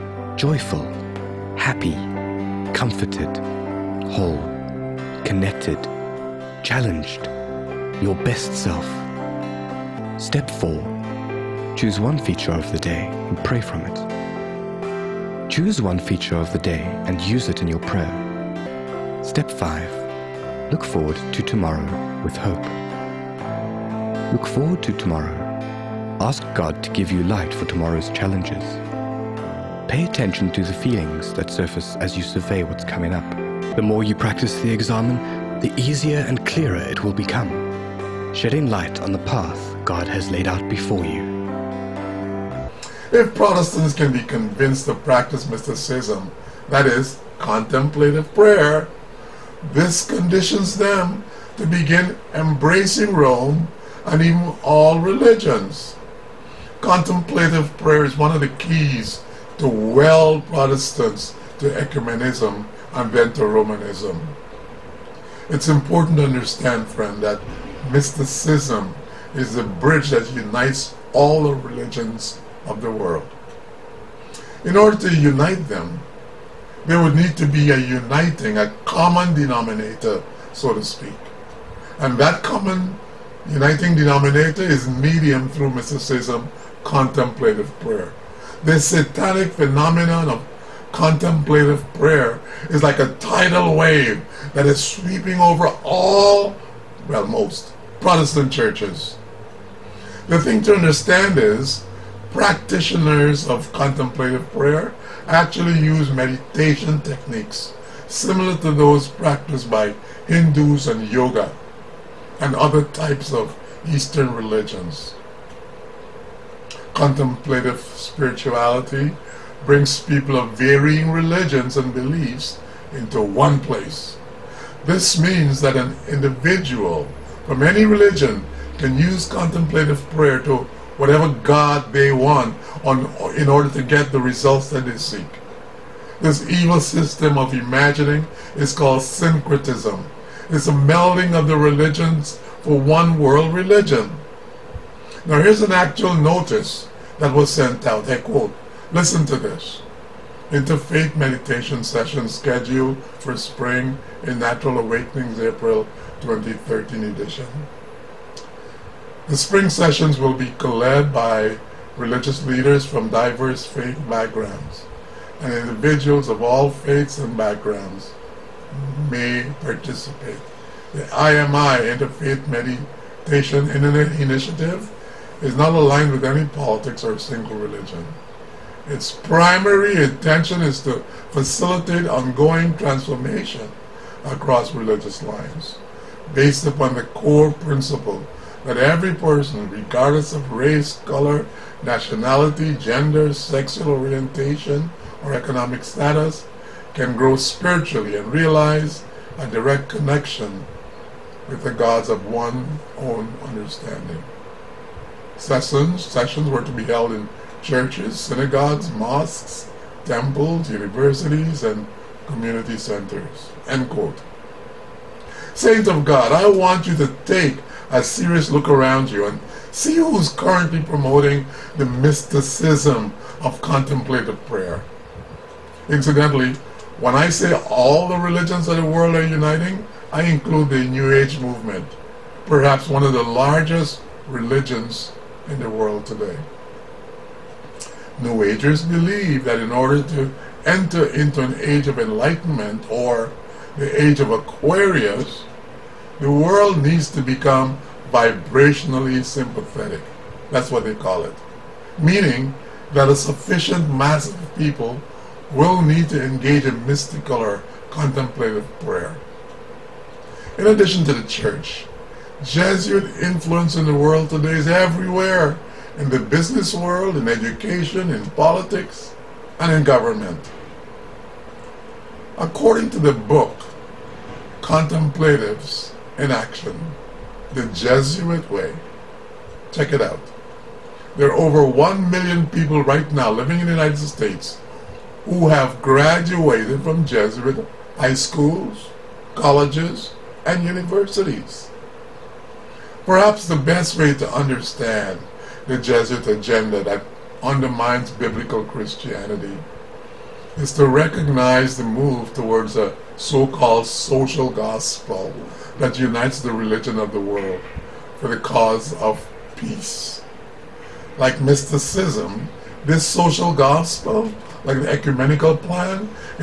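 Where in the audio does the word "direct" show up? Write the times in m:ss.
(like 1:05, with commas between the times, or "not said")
3:19.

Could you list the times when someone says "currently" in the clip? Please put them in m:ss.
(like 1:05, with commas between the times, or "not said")
3:40.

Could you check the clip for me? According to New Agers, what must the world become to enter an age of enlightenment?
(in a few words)
Vibrationally sympathetic.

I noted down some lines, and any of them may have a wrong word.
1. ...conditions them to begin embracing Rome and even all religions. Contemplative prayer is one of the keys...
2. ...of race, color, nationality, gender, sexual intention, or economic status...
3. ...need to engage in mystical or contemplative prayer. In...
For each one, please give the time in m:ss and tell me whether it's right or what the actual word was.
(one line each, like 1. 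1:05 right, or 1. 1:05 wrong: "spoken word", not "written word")
1. 0:50 right
2. 3:10 wrong: "orientation", not "intention"
3. 4:15 right.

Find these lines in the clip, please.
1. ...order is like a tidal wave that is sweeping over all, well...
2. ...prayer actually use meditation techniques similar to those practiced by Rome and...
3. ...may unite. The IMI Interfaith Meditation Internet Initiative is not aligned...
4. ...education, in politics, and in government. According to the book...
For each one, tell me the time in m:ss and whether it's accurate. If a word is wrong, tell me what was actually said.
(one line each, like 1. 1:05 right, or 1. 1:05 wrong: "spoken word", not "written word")
1. 1:31 wrong: "prayer", not "order"
2. 1:44 wrong: "Hindus", not "Rome"
3. 2:49 wrong: "participate", not "unite"
4. 4:27 right.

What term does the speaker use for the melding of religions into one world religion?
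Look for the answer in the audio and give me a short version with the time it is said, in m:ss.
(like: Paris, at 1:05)
Syncretism, at 2:19.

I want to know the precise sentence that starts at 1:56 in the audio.
Contemplative spirituality brings people of varying religions and beliefs into one place.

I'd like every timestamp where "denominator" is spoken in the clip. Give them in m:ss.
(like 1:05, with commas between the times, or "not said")
1:19, 1:23.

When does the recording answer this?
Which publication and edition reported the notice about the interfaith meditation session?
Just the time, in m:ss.
2:34.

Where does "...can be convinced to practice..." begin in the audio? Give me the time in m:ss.
0:43.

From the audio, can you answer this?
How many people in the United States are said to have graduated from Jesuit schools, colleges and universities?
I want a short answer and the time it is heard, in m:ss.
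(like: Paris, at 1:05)
Over 1 million, at 4:41.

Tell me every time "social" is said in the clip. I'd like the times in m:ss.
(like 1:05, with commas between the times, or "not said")
5:03, 5:13.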